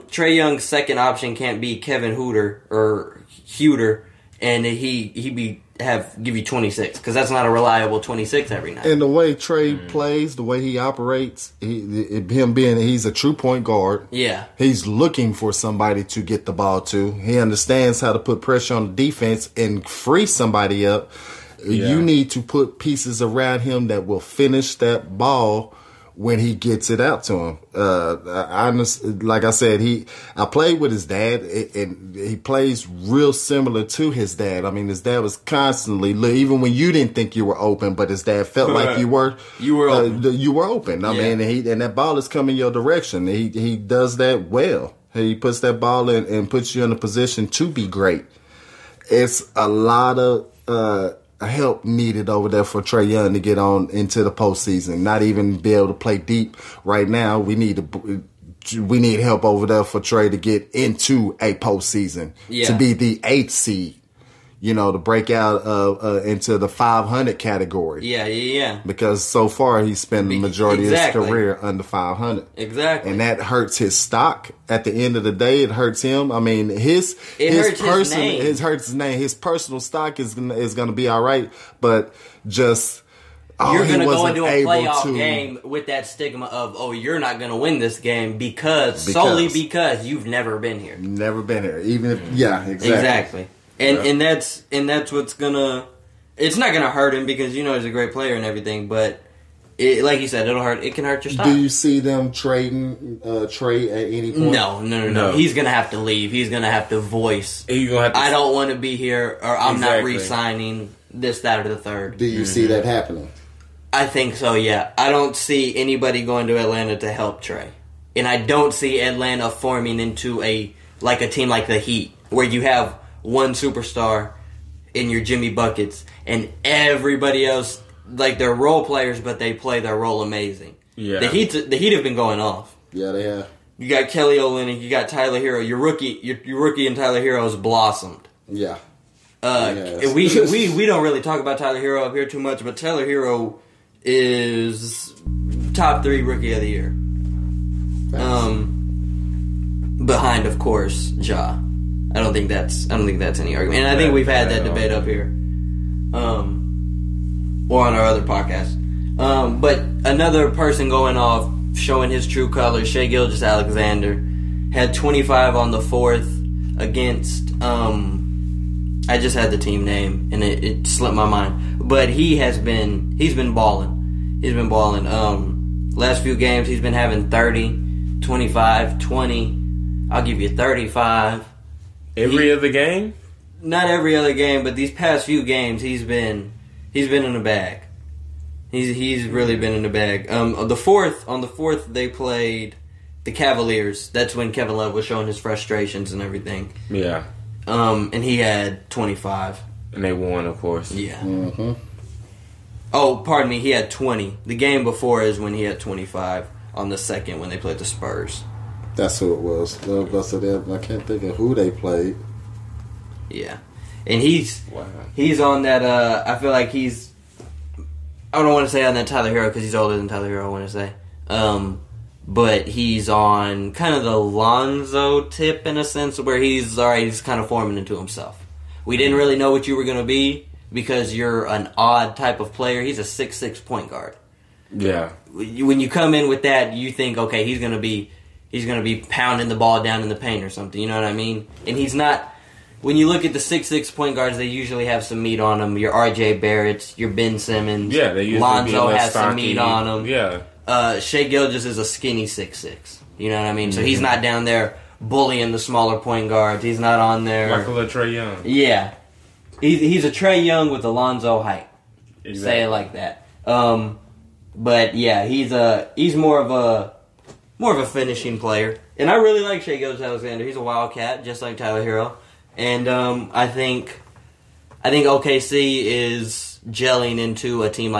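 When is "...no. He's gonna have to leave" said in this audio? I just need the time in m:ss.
1:45.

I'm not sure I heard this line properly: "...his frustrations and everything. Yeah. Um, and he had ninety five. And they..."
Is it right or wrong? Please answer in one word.
wrong.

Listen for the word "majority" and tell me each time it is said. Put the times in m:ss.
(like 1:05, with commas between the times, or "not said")
1:10.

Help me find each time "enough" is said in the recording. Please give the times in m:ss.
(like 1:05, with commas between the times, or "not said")
not said.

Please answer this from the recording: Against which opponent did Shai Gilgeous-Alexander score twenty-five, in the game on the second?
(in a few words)
Spurs.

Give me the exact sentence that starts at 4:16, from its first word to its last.
He's not on there like Trae Young.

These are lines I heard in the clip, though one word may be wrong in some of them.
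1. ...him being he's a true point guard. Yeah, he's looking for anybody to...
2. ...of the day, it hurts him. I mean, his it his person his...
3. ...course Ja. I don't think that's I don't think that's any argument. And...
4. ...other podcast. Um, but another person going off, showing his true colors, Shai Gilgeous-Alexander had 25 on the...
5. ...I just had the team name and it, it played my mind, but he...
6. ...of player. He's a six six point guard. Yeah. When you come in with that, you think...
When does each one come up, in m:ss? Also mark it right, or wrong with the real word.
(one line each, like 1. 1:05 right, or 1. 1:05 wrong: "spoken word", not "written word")
1. 0:12 wrong: "somebody", not "anybody"
2. 1:15 right
3. 2:30 right
4. 2:38 right
5. 2:49 wrong: "slipped", not "played"
6. 3:52 right.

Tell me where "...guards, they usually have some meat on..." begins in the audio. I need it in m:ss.
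4:04.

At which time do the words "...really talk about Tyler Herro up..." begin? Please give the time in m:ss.
2:21.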